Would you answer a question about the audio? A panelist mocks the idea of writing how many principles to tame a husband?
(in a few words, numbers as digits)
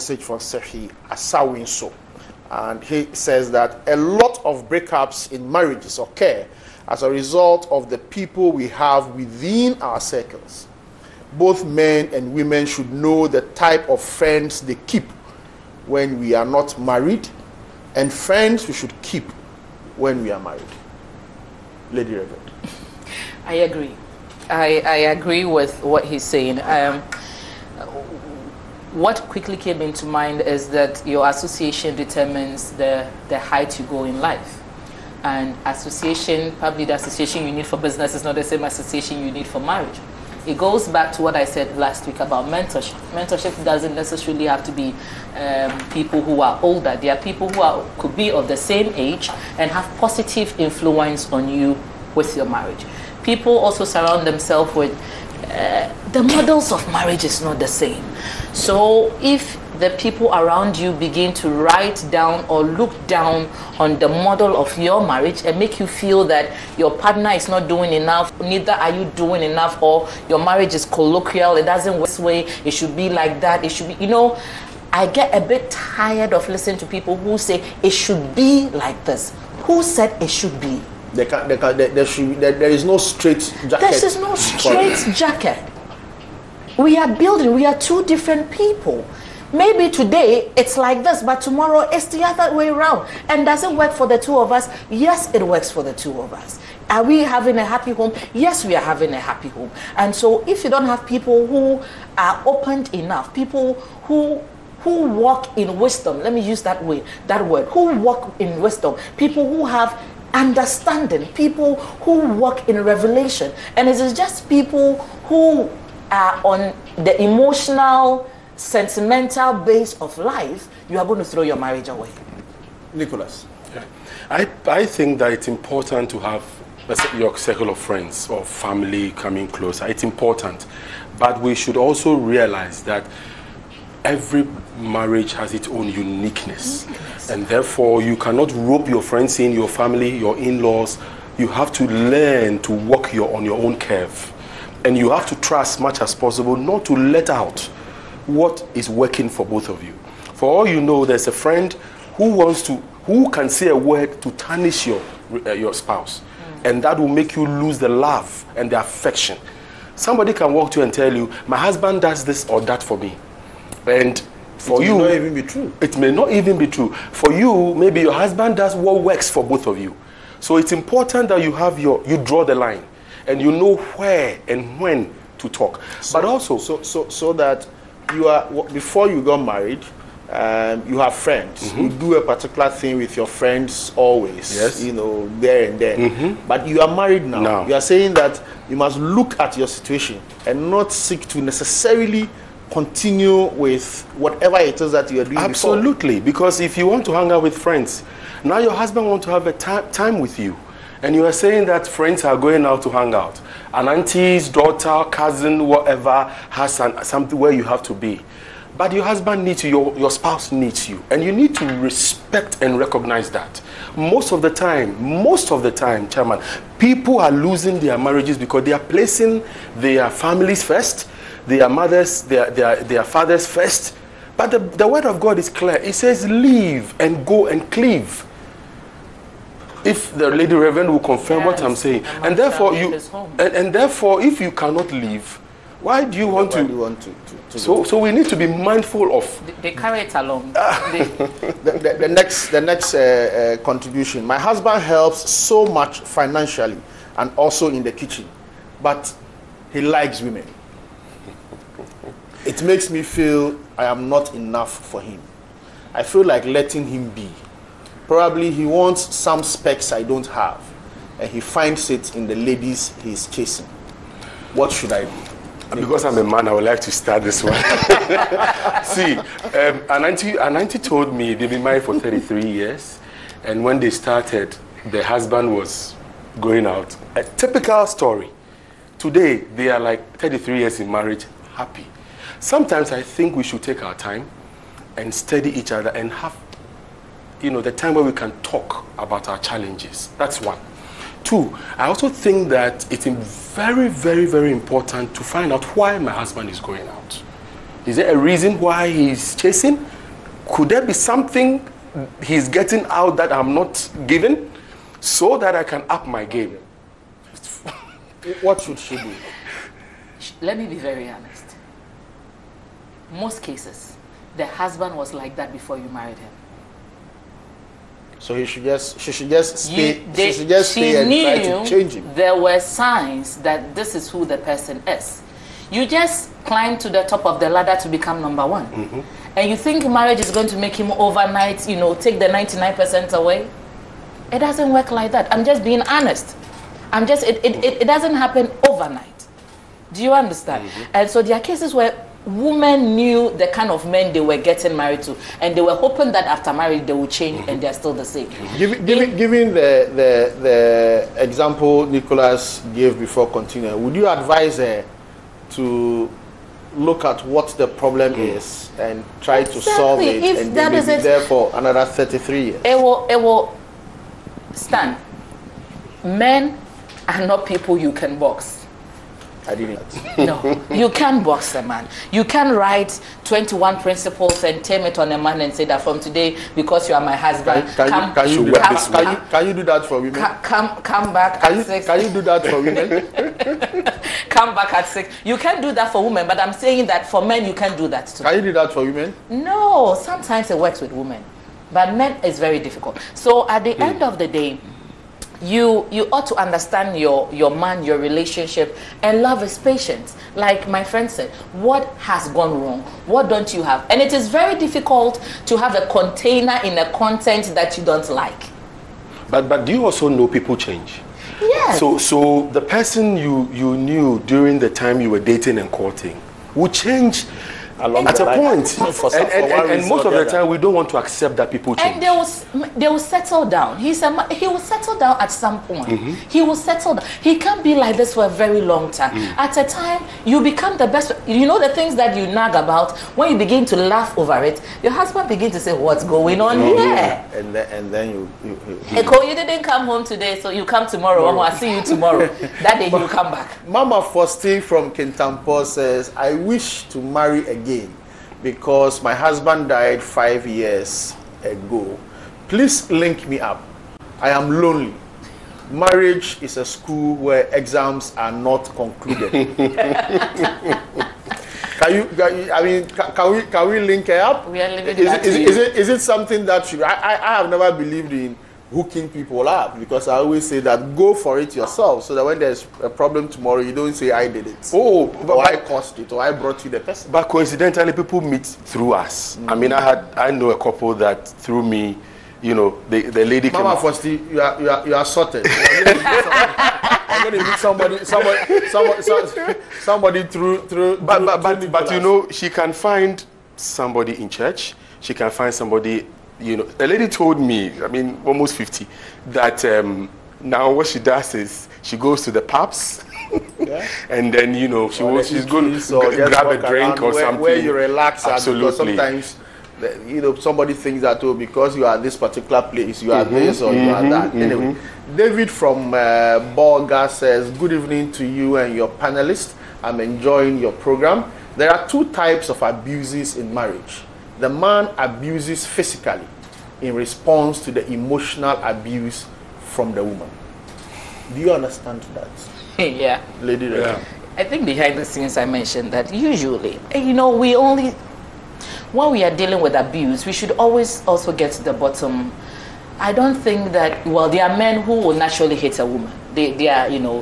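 21.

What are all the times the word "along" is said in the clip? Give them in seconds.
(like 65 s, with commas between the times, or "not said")
240 s, 417 s.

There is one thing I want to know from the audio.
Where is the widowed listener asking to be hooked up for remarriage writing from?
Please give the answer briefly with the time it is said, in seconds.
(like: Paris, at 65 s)
Kintampo, at 444 s.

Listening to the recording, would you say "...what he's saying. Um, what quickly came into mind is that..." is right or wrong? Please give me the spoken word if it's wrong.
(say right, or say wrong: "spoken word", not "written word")
right.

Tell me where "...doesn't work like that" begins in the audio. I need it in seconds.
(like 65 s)
334 s.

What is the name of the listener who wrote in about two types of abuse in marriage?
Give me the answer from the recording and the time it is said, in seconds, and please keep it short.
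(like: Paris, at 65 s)
David, at 515 s.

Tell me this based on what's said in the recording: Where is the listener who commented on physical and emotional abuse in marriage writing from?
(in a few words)
Borga.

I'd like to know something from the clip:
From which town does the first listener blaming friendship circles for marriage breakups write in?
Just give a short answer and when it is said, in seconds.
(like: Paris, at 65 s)
Sefwi Asawinso, at 0 s.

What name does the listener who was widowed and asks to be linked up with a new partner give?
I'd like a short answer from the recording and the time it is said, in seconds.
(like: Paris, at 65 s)
Mama Faustine, at 443 s.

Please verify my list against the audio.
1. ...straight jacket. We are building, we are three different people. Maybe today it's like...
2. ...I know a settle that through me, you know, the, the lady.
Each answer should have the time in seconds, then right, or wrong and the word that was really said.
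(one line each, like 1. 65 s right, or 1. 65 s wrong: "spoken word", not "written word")
1. 84 s wrong: "two", not "three"
2. 480 s wrong: "couple", not "settle".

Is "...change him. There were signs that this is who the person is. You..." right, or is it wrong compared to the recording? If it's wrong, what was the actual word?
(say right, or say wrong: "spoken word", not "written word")
right.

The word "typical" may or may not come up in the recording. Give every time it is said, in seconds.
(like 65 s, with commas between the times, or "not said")
277 s.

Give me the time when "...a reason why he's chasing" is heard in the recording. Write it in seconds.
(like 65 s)
298 s.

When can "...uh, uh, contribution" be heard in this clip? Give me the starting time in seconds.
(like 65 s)
242 s.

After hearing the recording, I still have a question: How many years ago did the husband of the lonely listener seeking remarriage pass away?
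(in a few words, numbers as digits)
5.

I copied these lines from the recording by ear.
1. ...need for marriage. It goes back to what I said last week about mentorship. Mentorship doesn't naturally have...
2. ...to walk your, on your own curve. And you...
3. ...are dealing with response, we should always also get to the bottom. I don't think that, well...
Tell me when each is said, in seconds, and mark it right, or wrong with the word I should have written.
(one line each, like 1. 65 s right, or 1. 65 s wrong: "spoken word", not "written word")
1. 39 s wrong: "necessarily", not "naturally"
2. 142 s right
3. 539 s wrong: "abuse", not "response".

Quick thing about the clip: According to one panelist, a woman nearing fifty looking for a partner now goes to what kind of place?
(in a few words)
The pubs.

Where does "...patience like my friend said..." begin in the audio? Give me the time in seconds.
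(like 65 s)
399 s.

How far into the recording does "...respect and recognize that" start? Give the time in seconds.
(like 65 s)
211 s.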